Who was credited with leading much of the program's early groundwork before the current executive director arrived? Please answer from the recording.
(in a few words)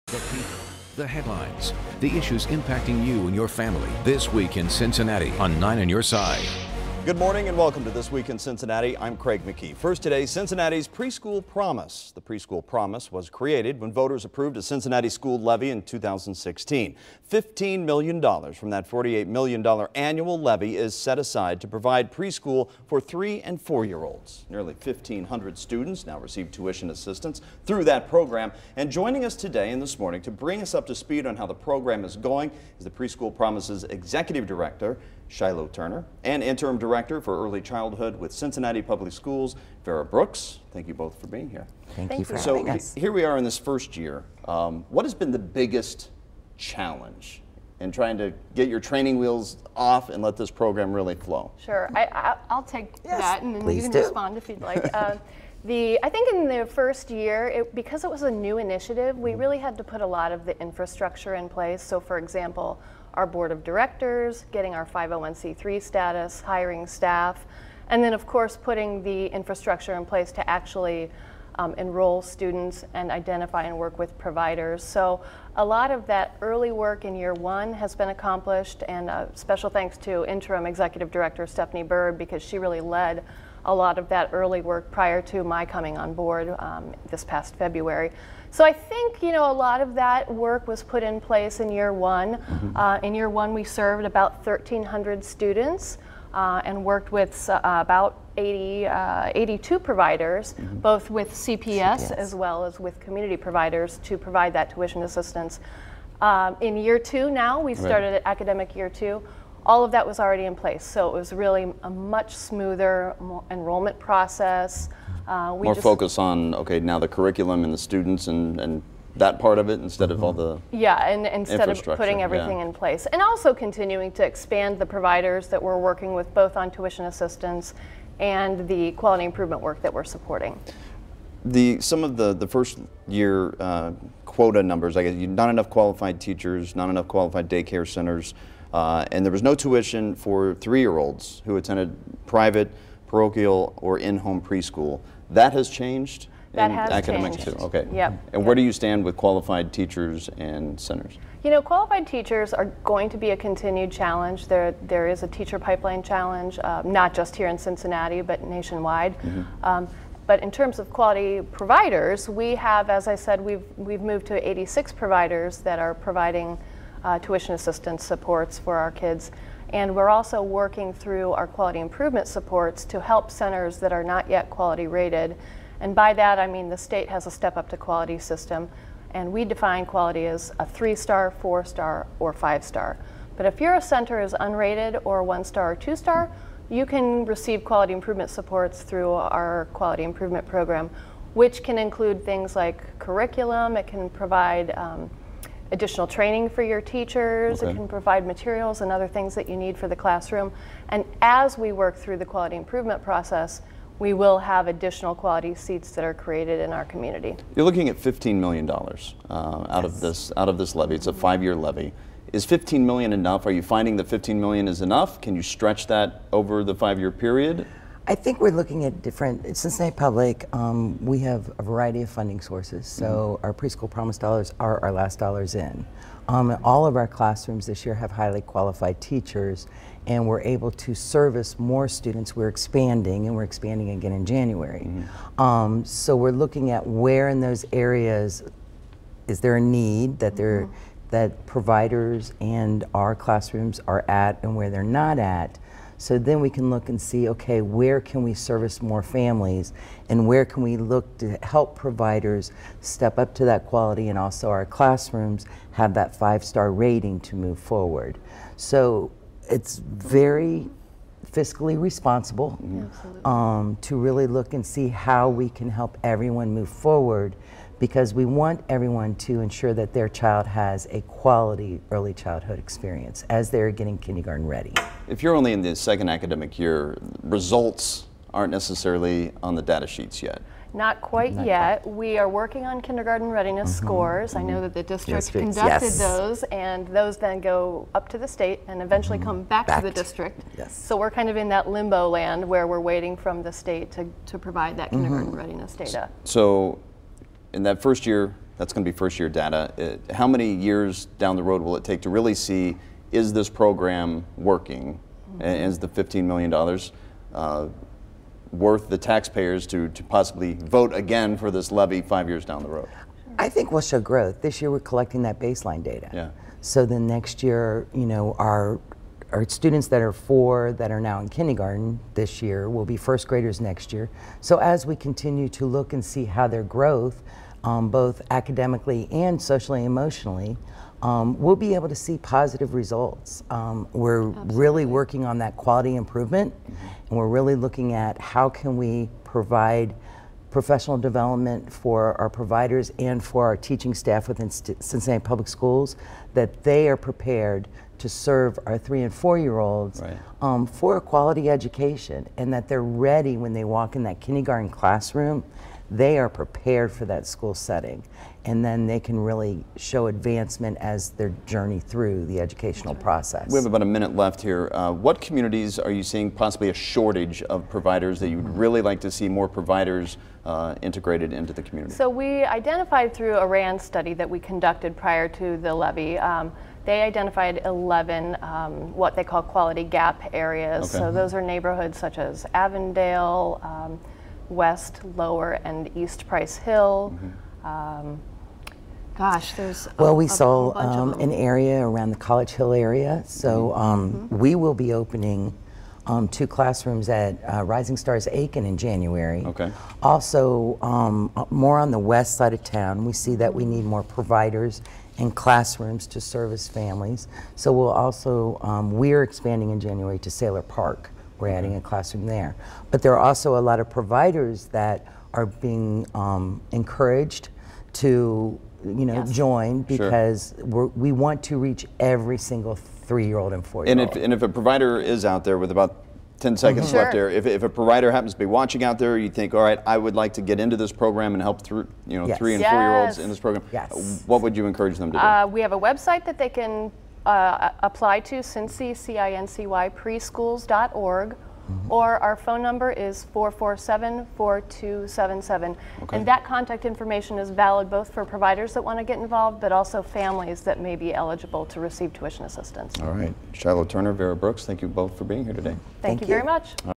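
Stephanie Byrd.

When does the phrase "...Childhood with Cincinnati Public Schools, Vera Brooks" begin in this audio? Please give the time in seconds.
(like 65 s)
37 s.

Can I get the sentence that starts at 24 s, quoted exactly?
Nearly 1,500 students now receive tuition assistance through that program.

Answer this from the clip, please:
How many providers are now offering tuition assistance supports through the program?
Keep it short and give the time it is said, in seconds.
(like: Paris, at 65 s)
86, at 164 s.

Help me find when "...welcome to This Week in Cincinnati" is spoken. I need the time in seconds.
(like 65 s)
7 s.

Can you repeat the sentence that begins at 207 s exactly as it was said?
You're looking at $15 million uh, out yes.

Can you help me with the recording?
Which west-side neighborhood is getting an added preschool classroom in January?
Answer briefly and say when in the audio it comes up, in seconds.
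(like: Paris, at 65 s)
Sayler Park, at 410 s.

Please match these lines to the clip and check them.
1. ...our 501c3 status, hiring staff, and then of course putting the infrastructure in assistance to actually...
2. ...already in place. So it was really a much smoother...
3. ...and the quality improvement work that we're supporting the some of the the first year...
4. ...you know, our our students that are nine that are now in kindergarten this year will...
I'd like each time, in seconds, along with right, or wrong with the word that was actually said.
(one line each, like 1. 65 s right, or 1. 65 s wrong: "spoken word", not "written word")
1. 64 s wrong: "place", not "assistance"
2. 110 s right
3. 128 s right
4. 317 s wrong: "four", not "nine".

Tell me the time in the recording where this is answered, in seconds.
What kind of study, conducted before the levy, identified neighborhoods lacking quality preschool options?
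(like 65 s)
373 s.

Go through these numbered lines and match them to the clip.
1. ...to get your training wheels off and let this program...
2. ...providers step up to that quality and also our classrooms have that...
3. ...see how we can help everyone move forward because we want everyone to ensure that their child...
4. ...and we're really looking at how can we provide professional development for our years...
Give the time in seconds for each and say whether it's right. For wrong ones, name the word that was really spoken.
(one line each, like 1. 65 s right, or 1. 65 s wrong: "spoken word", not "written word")
1. 48 s right
2. 251 s right
3. 264 s right
4. 336 s wrong: "providers", not "years".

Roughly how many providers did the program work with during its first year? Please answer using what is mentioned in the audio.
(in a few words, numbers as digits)
82.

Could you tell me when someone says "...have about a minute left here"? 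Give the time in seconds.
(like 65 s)
363 s.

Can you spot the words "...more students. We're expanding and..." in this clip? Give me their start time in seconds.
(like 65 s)
231 s.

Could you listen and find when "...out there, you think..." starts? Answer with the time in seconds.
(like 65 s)
428 s.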